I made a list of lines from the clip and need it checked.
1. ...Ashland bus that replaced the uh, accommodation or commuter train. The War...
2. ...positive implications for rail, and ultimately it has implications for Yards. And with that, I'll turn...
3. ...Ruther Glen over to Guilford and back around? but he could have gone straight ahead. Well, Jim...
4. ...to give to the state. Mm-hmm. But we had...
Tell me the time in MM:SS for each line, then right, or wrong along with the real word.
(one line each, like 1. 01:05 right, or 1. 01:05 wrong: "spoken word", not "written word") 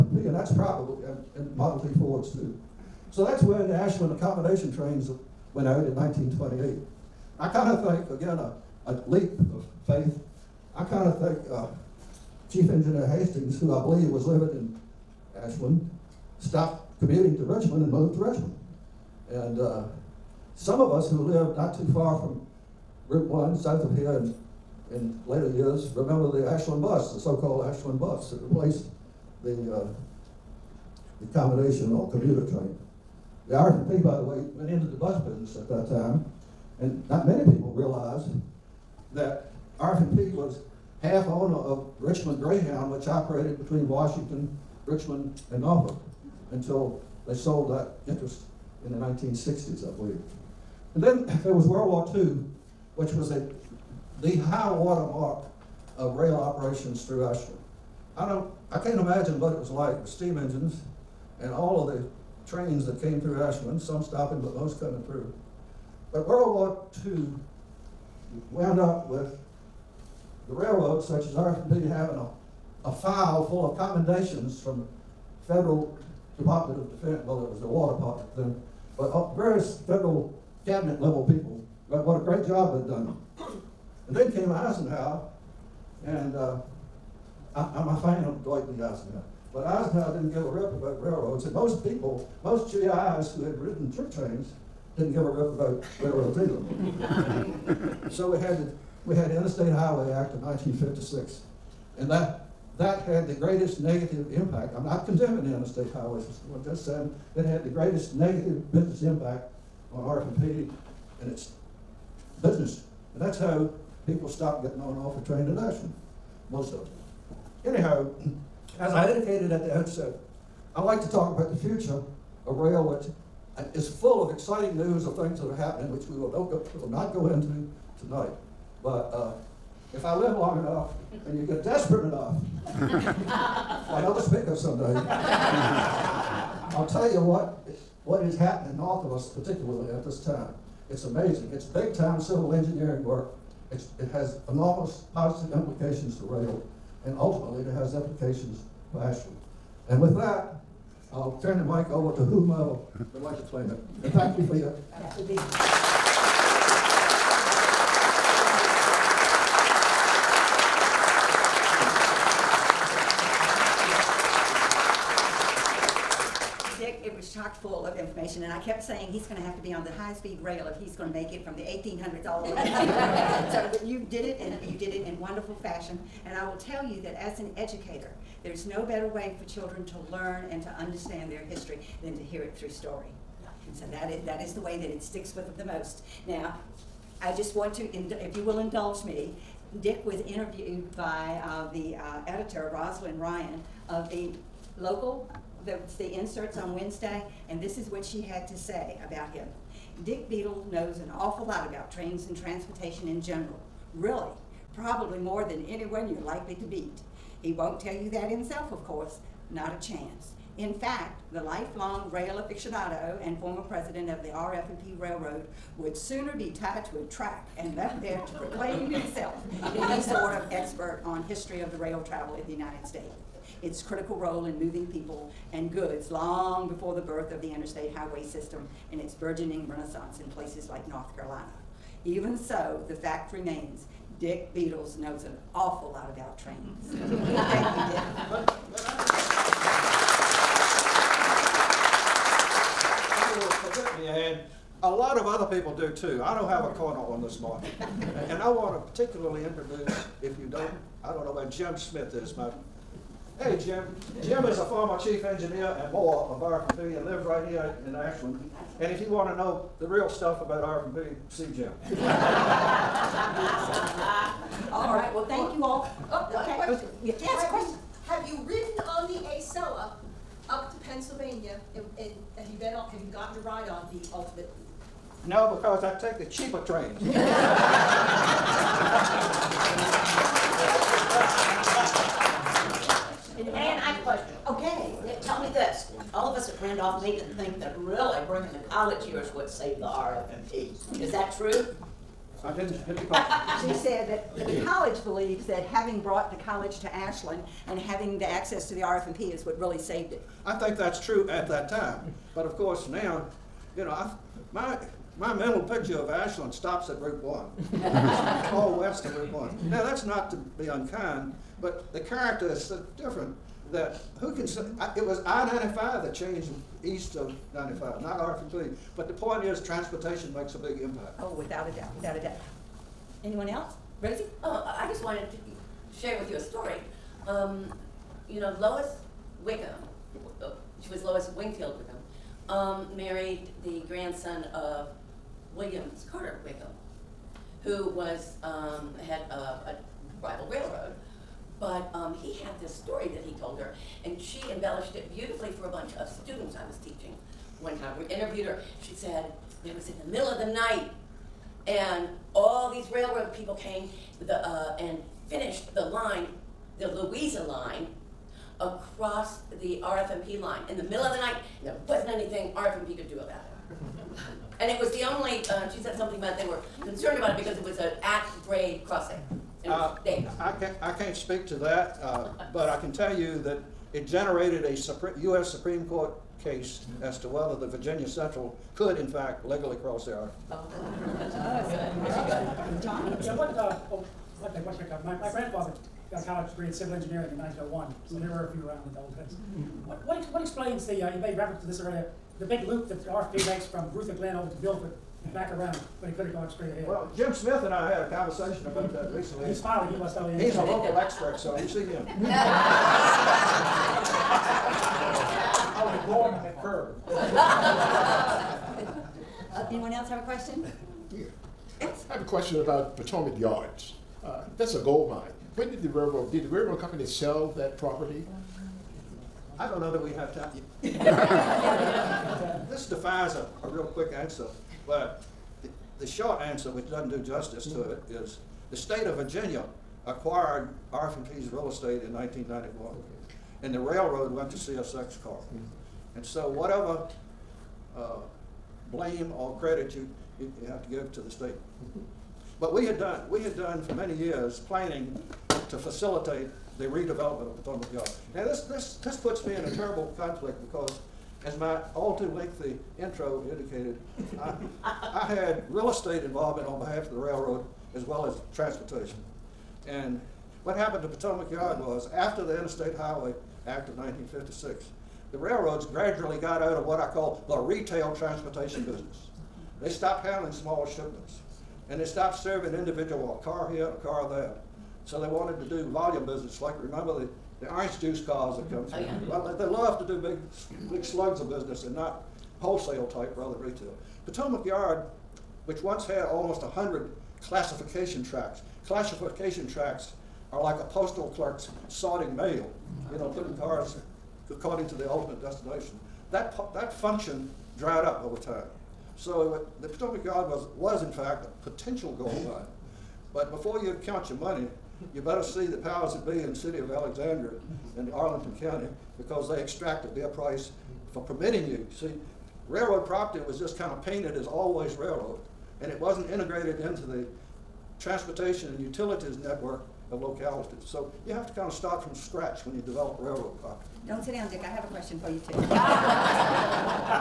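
1. 00:27 wrong: "RFP", not "War"
2. 02:25 wrong: "Ashland", not "Yards"
3. 06:33 right
4. 07:20 right.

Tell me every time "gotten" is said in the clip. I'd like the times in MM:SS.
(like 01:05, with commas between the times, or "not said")
04:33.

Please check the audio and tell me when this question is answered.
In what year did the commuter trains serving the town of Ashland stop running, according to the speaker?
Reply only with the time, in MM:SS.
00:05.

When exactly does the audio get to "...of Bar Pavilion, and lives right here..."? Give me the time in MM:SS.
04:16.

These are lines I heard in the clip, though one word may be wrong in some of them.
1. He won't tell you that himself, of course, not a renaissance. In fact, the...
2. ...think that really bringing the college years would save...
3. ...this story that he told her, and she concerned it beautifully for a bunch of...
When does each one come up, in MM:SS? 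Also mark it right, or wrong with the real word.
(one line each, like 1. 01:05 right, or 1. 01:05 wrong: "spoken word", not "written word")
1. 03:27 wrong: "chance", not "renaissance"
2. 04:47 right
3. 05:42 wrong: "embellished", not "concerned".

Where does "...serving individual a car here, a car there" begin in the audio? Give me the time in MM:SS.
07:52.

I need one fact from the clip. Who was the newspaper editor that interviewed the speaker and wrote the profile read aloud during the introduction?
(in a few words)
Rosalind Ryan.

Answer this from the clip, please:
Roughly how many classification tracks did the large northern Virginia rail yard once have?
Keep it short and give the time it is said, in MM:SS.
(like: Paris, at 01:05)
100, at 08:06.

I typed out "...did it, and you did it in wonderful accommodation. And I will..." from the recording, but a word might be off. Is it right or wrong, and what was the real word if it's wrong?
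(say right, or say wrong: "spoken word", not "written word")
wrong: "fashion", not "accommodation".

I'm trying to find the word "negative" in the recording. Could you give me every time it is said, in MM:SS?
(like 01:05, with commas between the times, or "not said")
01:43, 01:48.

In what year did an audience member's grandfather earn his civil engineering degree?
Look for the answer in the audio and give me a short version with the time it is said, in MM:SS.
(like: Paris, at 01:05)
1901, at 06:27.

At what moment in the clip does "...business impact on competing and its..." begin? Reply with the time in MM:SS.
01:48.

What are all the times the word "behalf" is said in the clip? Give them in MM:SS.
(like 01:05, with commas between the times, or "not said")
07:36.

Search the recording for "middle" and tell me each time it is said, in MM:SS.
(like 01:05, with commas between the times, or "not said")
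05:50, 06:00.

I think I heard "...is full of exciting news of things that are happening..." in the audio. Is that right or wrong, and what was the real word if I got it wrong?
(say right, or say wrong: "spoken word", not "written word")
right.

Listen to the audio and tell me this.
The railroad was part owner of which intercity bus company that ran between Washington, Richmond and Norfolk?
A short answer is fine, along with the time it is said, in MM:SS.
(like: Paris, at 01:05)
Richmond Greyhound, at 00:41.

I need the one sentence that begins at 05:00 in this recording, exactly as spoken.
I think that's true at that time.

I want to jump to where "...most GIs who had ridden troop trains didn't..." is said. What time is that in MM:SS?
01:32.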